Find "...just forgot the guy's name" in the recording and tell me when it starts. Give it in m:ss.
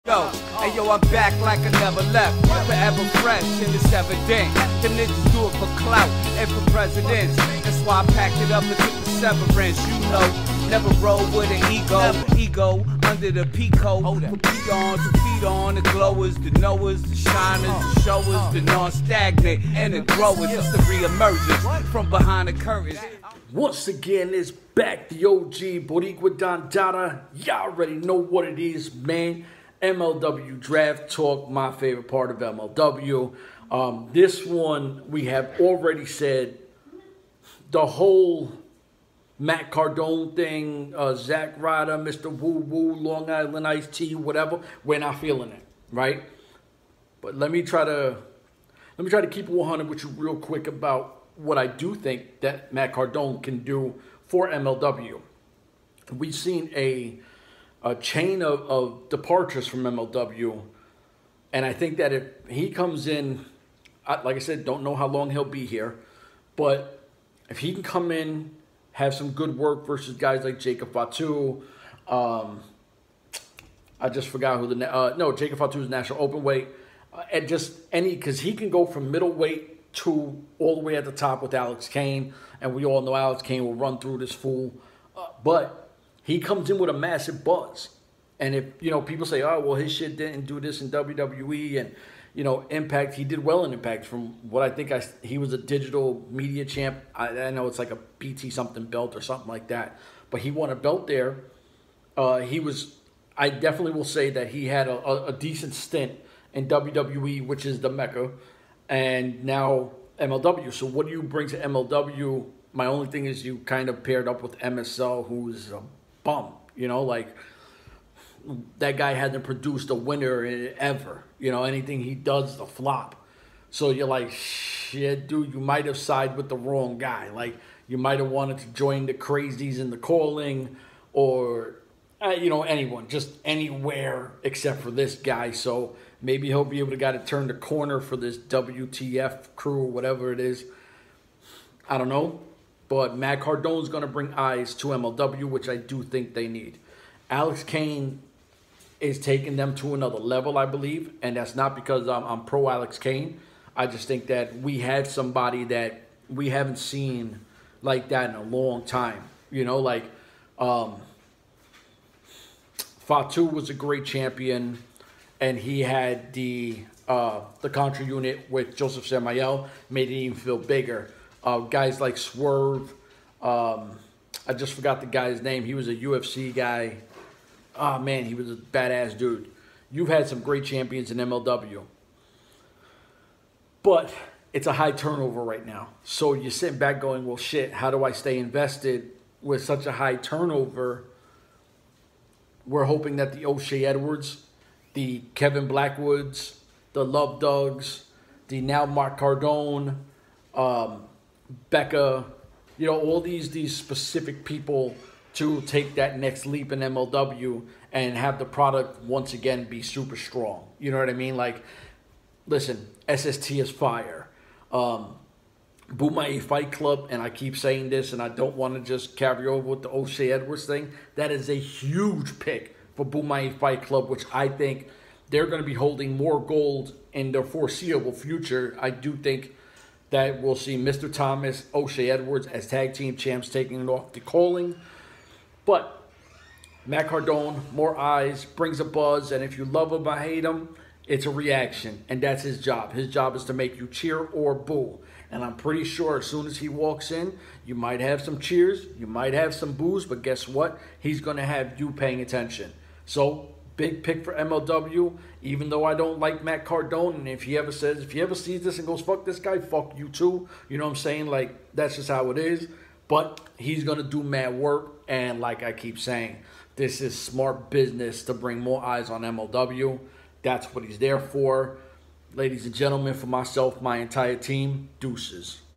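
2:54.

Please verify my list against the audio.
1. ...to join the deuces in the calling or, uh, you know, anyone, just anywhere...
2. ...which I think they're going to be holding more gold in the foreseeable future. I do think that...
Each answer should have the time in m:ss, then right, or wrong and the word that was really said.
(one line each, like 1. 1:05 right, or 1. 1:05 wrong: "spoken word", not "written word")
1. 2:08 wrong: "crazies", not "deuces"
2. 3:44 right.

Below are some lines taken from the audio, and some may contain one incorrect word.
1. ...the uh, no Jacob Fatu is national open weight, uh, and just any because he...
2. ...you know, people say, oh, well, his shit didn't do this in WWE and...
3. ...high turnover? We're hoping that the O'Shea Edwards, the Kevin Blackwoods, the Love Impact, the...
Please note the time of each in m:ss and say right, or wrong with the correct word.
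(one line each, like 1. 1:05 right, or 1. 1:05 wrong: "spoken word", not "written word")
1. 1:14 right
2. 1:28 right
3. 3:09 wrong: "Dogs", not "Impact".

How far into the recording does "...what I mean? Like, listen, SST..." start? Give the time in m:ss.
3:30.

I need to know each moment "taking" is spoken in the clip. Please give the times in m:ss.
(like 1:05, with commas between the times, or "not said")
2:29, 3:53.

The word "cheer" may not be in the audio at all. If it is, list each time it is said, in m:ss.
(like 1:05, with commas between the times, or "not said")
4:03, 4:08.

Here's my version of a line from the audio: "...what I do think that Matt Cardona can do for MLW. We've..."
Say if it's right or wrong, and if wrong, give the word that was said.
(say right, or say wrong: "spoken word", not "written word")
right.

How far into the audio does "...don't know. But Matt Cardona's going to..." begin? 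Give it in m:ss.
2:21.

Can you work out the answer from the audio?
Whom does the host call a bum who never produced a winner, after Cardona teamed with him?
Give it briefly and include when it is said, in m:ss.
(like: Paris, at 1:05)
MSL, at 1:54.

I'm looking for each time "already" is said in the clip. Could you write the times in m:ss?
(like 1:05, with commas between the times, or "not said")
0:27, 0:35.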